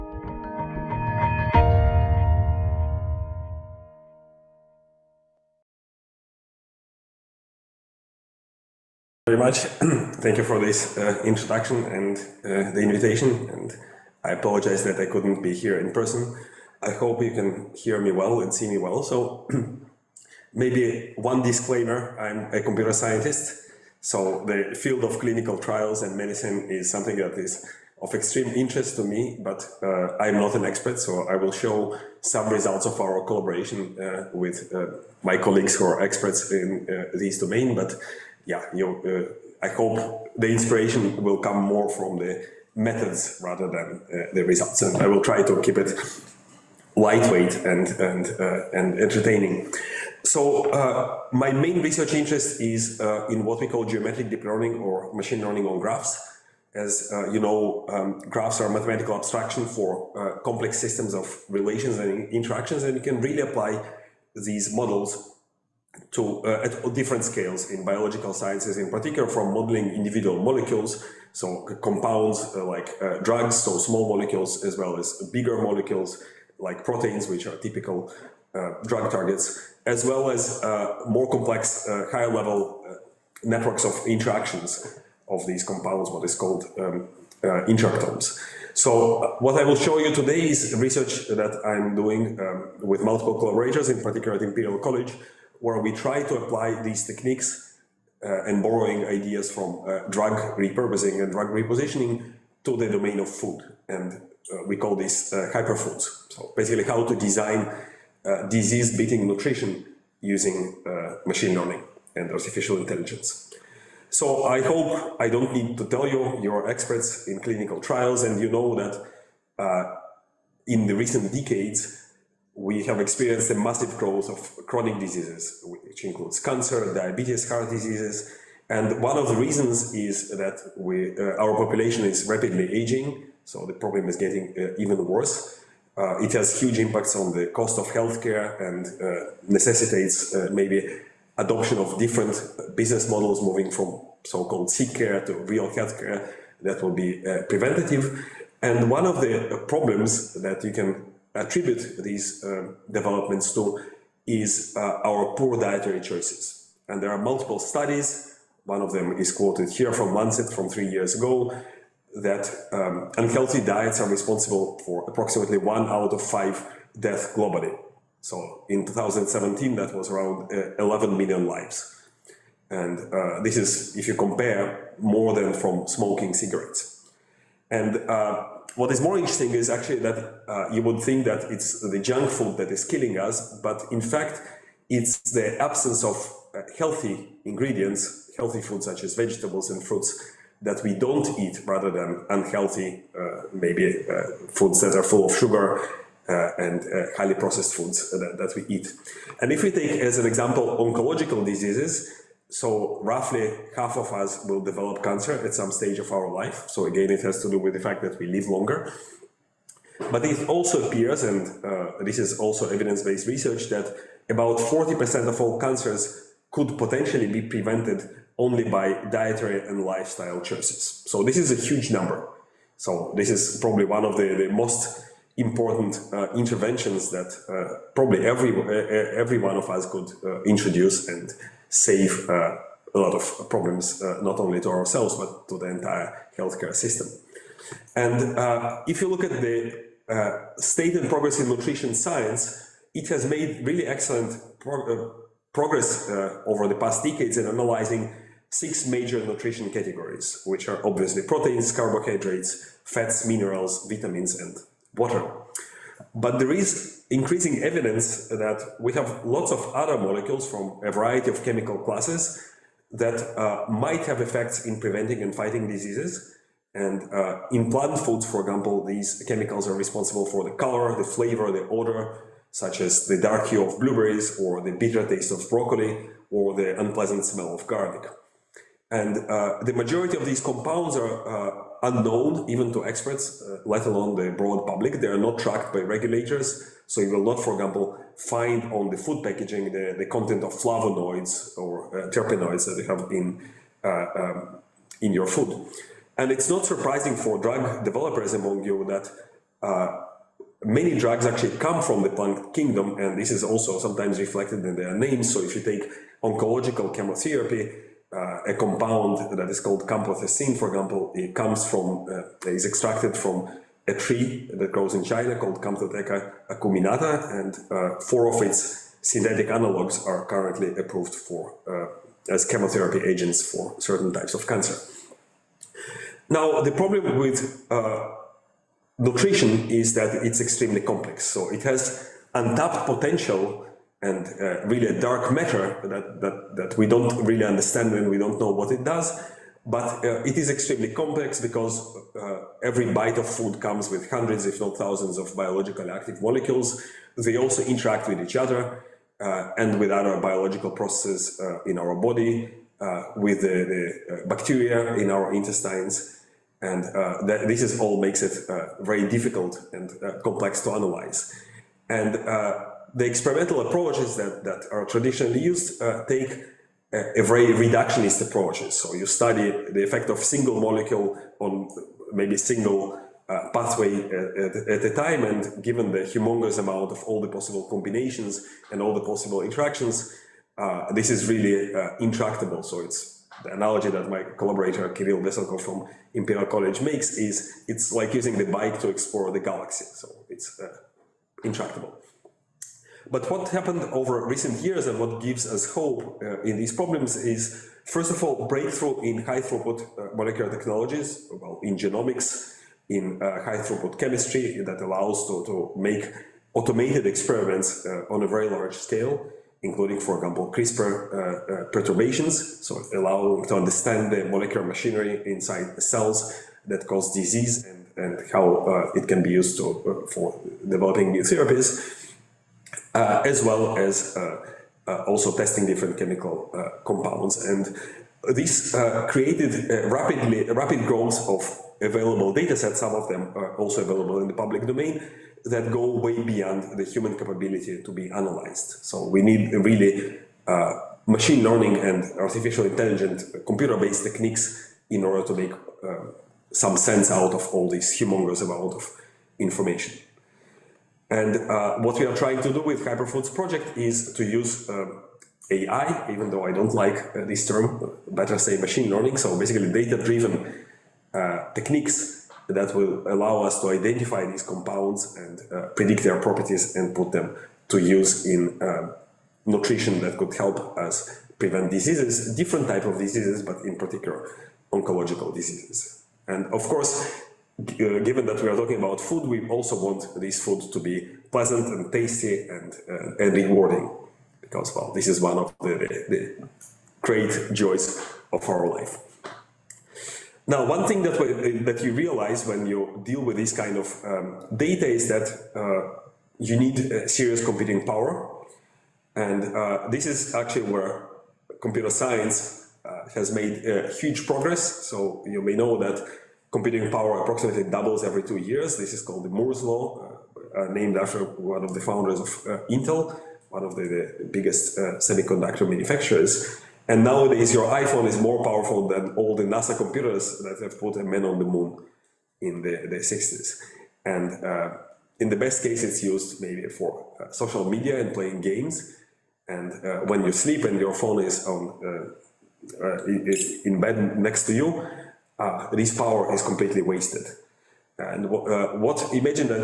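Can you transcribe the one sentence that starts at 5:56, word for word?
And that, this is all makes it very difficult and complex to analyze.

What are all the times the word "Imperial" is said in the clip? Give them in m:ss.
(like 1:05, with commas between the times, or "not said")
1:34, 6:26.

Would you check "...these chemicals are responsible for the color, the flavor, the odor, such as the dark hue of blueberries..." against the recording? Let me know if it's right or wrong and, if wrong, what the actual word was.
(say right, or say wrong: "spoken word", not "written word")
right.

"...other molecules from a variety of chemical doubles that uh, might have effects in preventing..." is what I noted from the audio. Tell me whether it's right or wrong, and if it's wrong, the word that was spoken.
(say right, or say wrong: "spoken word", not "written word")
wrong: "classes", not "doubles".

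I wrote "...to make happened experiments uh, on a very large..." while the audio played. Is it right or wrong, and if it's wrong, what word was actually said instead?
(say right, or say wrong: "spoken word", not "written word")
wrong: "automated", not "happened".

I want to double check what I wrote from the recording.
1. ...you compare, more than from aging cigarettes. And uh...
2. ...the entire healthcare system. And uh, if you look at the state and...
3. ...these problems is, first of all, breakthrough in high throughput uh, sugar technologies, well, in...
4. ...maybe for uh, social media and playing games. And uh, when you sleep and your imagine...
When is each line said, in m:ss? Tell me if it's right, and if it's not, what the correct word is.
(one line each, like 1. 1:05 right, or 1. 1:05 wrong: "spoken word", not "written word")
1. 2:54 wrong: "smoking", not "aging"
2. 3:55 right
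3. 6:36 wrong: "molecular", not "sugar"
4. 8:46 wrong: "phone", not "imagine".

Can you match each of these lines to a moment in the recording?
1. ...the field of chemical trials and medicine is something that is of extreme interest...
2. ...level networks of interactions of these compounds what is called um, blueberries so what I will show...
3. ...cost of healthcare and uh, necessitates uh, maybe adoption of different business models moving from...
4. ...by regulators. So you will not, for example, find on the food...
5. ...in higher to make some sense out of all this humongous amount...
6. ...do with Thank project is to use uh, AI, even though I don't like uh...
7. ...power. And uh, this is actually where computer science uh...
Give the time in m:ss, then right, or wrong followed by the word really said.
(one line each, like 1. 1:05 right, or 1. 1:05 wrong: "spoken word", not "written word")
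1. 0:24 wrong: "clinical", not "chemical"
2. 1:22 wrong: "interactomes", not "blueberries"
3. 2:17 right
4. 4:45 right
5. 7:24 wrong: "order", not "higher"
6. 7:32 wrong: "Hyperfoods", not "Thank"
7. 8:17 right.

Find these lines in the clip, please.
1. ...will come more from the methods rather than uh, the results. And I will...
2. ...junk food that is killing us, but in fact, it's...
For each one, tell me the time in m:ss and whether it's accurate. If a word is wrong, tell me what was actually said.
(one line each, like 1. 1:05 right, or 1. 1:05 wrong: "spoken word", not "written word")
1. 0:41 right
2. 3:01 right.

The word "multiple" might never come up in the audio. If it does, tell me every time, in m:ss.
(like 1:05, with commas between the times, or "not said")
1:33, 2:37.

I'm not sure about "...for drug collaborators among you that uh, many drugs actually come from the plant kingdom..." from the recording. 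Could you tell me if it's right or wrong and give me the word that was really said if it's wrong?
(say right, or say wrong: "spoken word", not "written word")
wrong: "developers", not "collaborators".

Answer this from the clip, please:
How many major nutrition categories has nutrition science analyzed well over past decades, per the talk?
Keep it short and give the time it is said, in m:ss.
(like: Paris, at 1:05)
6, at 4:08.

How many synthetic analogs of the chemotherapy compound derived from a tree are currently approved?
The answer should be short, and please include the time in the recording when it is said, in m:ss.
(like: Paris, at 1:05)
4, at 5:17.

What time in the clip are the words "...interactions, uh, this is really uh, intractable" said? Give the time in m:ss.
6:19.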